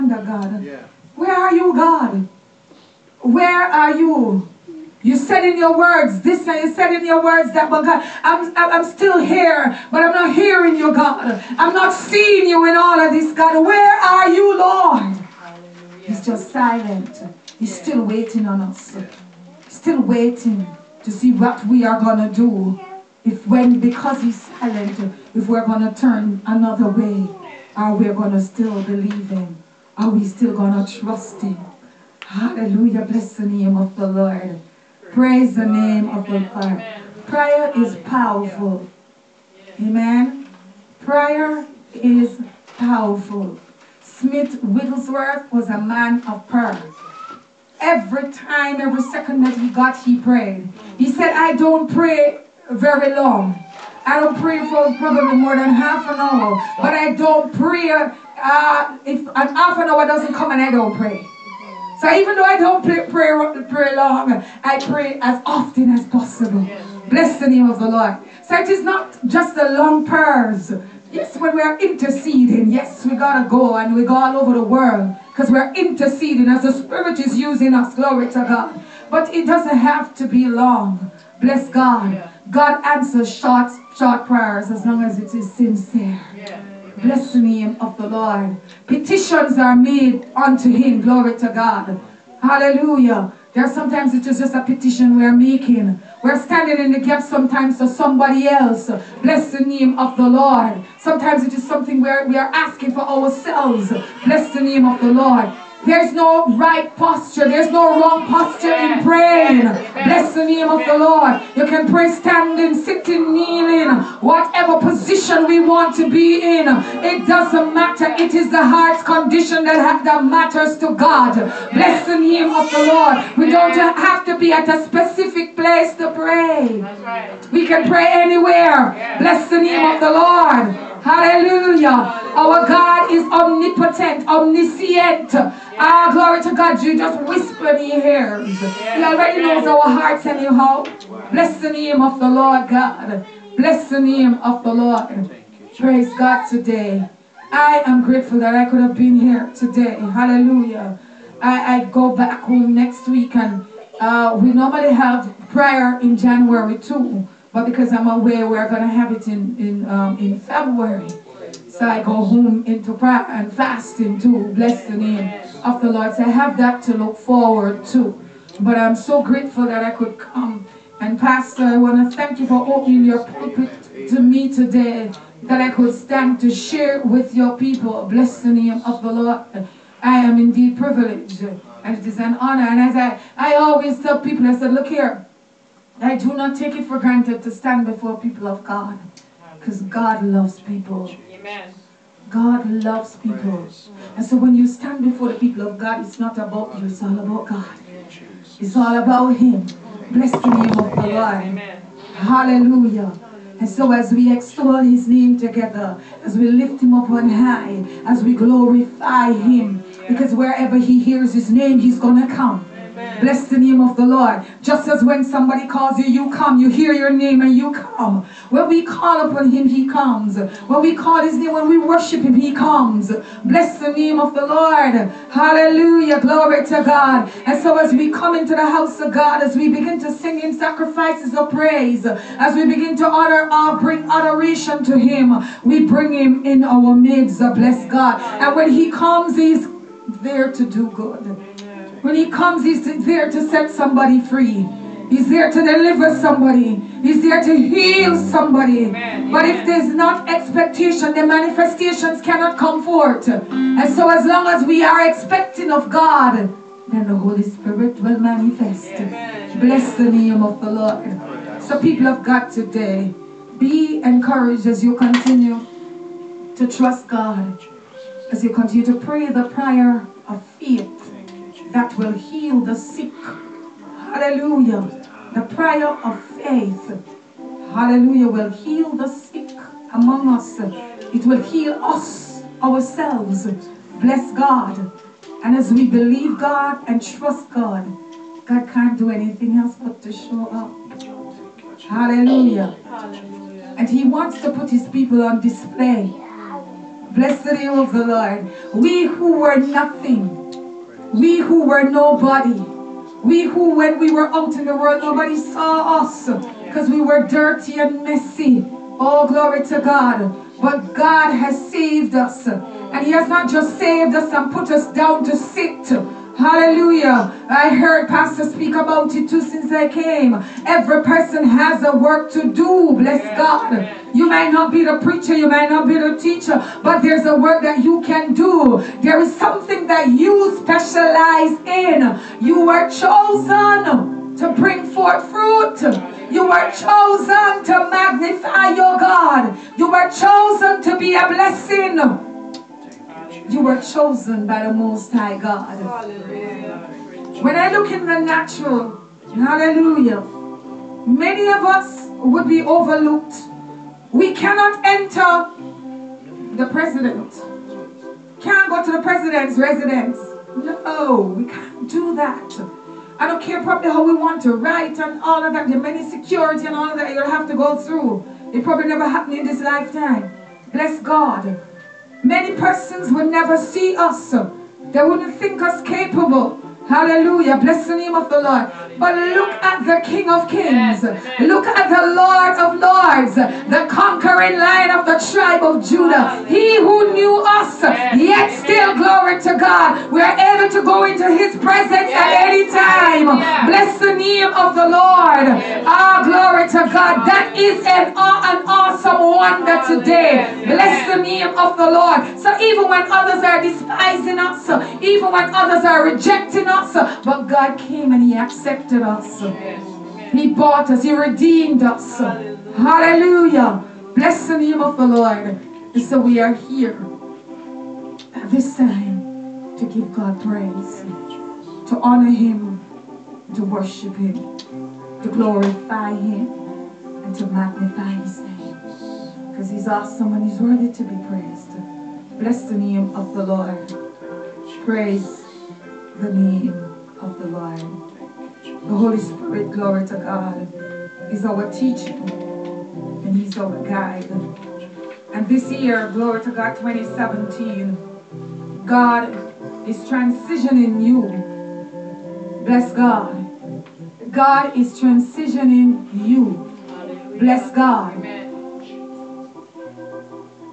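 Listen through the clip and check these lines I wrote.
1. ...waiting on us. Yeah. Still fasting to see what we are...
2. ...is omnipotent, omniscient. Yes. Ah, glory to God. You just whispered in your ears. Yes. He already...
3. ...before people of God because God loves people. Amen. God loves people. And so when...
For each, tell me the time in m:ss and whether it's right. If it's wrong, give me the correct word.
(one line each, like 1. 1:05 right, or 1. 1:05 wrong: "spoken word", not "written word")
1. 0:18 wrong: "waiting", not "fasting"
2. 2:13 right
3. 3:07 right.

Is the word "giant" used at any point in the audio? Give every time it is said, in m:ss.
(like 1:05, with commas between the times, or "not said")
not said.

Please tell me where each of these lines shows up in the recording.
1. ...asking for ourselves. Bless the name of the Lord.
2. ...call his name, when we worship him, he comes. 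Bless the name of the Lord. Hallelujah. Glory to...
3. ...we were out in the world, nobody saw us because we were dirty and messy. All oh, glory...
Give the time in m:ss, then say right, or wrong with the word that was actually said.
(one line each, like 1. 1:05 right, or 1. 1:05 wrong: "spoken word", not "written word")
1. 1:42 right
2. 3:40 right
3. 5:04 right.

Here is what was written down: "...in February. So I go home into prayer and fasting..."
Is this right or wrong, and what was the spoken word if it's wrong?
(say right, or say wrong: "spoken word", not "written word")
right.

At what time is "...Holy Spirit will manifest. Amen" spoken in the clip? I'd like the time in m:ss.
4:17.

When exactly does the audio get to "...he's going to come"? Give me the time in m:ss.
3:31.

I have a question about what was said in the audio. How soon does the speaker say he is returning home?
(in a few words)
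next week.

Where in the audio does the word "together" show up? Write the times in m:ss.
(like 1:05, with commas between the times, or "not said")
3:25.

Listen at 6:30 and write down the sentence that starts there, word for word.
We are able to go into his presence at any time.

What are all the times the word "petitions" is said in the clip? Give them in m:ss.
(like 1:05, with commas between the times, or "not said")
1:28, 1:34.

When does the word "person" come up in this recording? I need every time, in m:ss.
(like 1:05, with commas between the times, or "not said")
5:21, 6:12.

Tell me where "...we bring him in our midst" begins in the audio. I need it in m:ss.
3:55.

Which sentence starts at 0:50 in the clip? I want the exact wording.
He said, I don't pray very long.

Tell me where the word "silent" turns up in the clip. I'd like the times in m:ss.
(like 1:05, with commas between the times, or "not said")
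0:16, 0:24.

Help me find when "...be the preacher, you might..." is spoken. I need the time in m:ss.
5:24.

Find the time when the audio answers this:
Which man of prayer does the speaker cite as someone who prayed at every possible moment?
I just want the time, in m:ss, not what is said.
0:44.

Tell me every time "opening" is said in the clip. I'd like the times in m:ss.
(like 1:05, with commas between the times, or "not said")
2:52.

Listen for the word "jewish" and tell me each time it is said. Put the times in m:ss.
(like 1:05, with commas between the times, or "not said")
not said.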